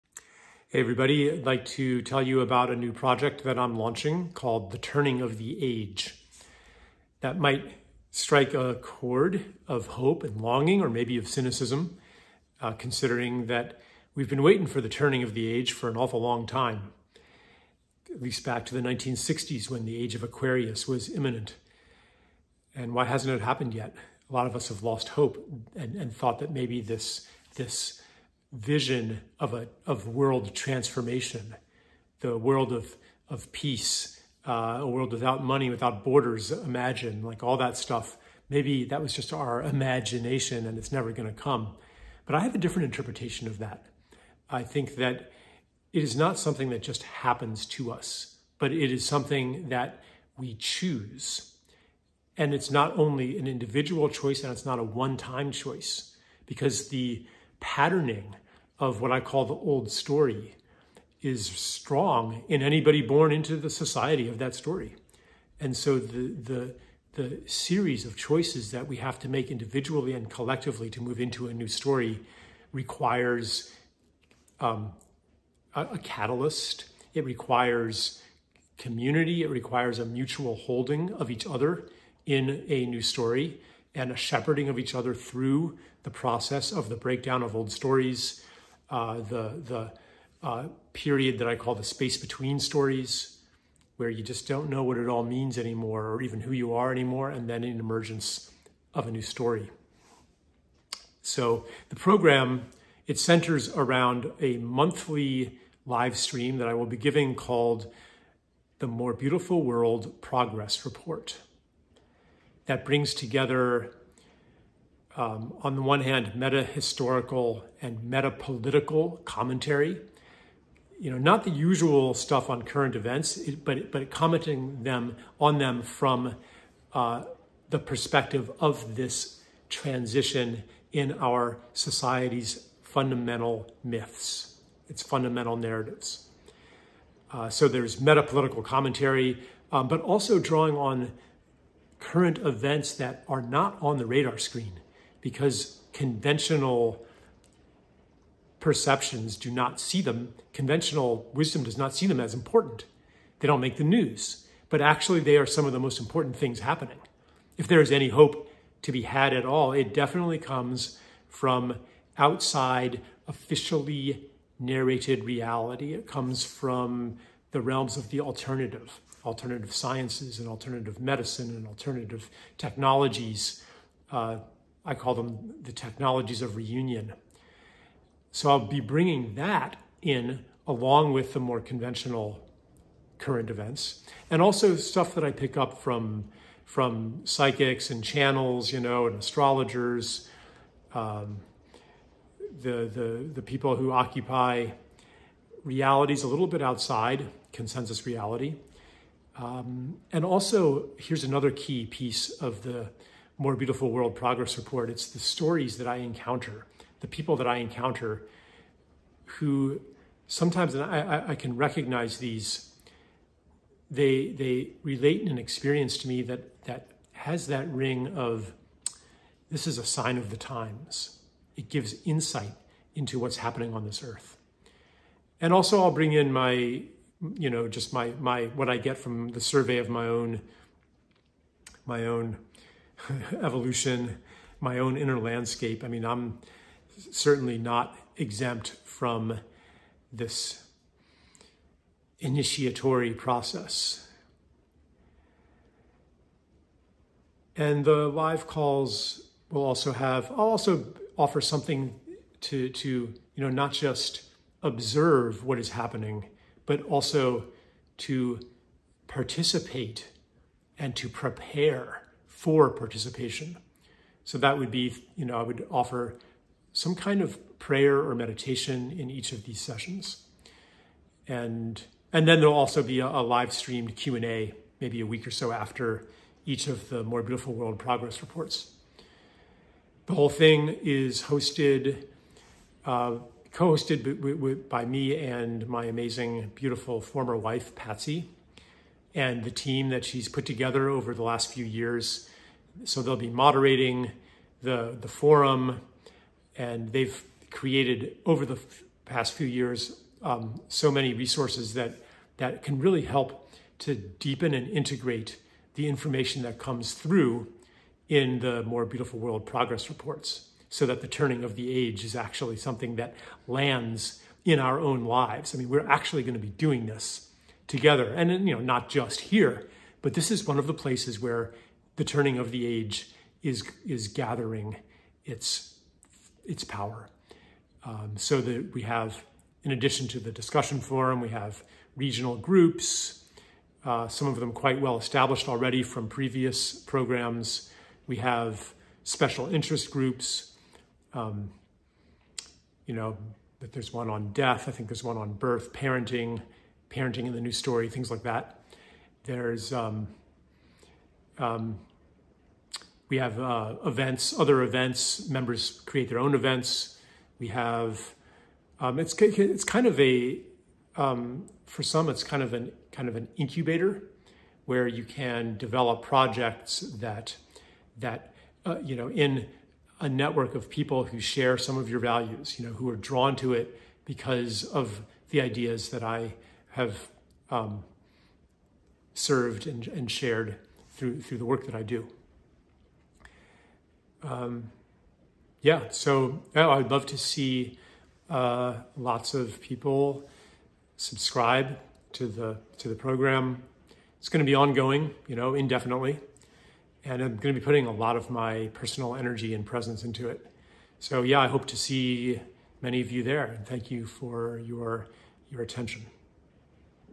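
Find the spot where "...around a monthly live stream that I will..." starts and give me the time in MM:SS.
01:43.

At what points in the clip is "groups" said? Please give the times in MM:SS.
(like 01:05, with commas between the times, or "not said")
05:32, 05:39.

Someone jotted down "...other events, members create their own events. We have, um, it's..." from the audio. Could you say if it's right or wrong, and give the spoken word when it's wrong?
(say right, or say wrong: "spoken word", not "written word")
right.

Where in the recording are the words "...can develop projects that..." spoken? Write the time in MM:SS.
06:05.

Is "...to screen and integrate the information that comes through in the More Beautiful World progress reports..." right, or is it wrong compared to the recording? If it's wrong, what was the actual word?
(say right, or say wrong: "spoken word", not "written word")
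wrong: "deepen", not "screen".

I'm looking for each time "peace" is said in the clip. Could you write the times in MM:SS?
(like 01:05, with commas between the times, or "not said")
00:33.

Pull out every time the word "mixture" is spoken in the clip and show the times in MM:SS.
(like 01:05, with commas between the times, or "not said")
not said.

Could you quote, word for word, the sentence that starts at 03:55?
I mean, I'm certainly not exempt from this initiatory process.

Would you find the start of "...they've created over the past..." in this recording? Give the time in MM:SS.
04:56.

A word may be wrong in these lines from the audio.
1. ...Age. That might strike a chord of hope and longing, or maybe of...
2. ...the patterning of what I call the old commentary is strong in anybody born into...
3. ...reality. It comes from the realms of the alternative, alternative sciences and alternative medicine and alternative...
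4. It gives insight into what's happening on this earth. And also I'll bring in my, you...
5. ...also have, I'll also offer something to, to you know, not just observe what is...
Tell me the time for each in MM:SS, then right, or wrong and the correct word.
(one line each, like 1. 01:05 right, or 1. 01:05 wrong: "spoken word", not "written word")
1. 00:05 right
2. 00:56 wrong: "story", not "commentary"
3. 02:45 right
4. 03:41 right
5. 04:09 right.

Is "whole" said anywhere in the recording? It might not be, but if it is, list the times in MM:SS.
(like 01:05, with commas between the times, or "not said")
04:40.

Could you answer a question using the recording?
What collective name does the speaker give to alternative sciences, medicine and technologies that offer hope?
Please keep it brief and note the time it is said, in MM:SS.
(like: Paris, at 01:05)
technologies of reunion, at 02:55.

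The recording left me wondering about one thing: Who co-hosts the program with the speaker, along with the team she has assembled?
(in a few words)
Patsy.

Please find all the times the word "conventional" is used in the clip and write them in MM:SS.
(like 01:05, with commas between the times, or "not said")
02:25, 02:30, 03:01.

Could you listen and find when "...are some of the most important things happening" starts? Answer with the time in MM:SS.
02:35.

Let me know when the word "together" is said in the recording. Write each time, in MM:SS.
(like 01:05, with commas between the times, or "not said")
01:53, 04:50, 05:17.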